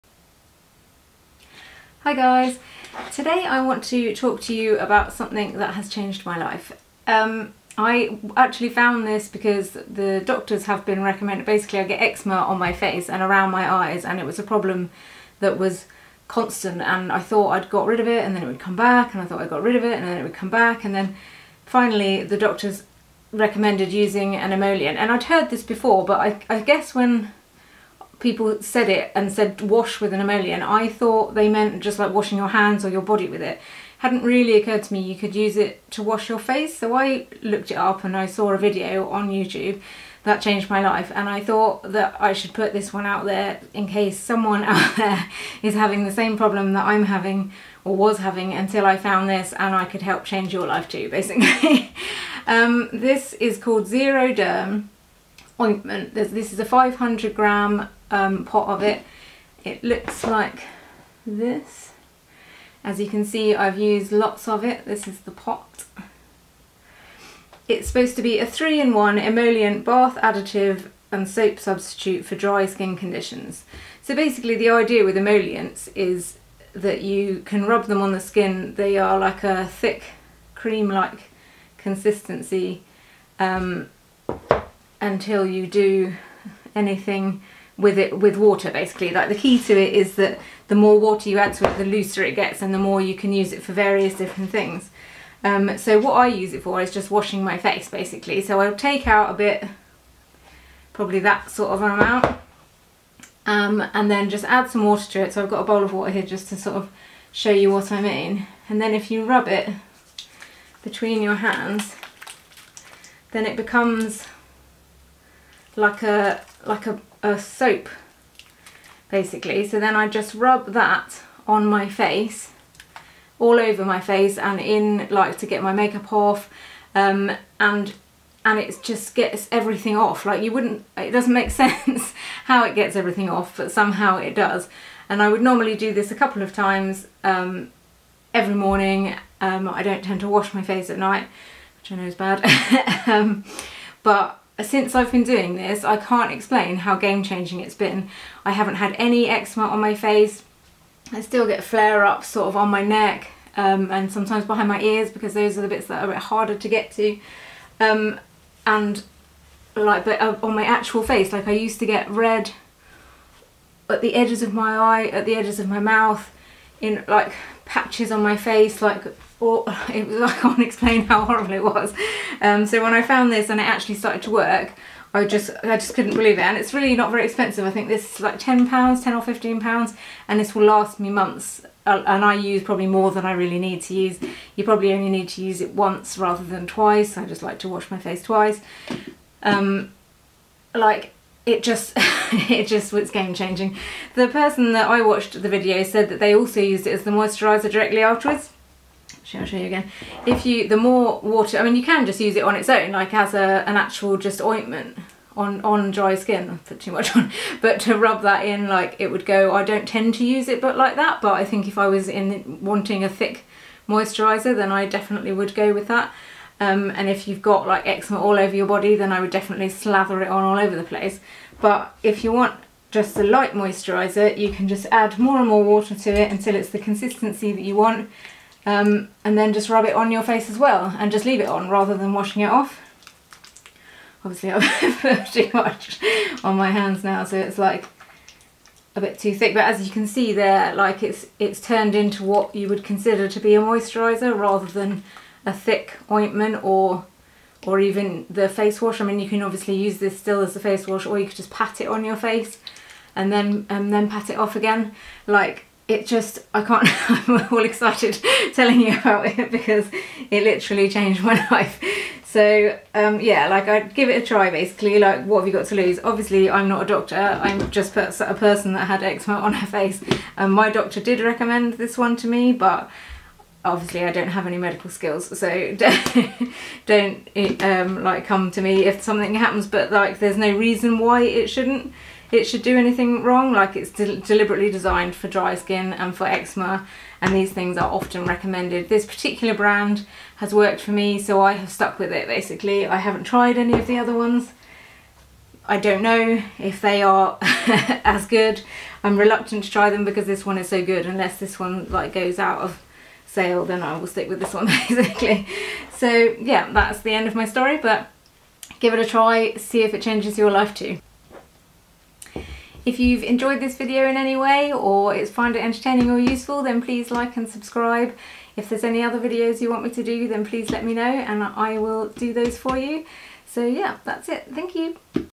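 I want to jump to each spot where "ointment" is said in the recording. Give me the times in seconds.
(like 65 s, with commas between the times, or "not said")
55 s, 204 s, 246 s.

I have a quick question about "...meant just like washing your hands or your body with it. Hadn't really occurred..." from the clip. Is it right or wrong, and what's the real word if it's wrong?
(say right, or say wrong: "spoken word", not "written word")
right.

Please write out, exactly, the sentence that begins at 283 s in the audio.
Like it's de deliberately designed for dry skin and for eczema and these things are often recommended.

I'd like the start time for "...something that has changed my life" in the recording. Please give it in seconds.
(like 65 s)
5 s.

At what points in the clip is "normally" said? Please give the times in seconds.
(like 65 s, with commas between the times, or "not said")
135 s.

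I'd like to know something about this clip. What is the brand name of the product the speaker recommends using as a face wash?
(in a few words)
Zeroderm.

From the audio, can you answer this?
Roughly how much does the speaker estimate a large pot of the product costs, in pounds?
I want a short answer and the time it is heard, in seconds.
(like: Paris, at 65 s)
10 or 15 pounds, at 179 s.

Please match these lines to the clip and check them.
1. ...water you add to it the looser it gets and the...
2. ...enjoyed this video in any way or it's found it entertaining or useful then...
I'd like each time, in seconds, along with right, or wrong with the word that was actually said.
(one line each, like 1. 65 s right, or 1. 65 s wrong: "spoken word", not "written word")
1. 90 s right
2. 313 s right.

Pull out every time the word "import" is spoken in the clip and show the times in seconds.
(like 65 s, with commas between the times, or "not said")
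not said.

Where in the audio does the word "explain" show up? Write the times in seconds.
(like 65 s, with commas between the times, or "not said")
146 s, 170 s.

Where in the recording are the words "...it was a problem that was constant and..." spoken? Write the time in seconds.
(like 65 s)
14 s.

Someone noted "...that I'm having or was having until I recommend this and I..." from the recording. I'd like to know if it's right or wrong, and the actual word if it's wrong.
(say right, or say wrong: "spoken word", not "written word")
wrong: "found", not "recommend".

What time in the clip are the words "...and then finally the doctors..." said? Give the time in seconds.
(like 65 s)
20 s.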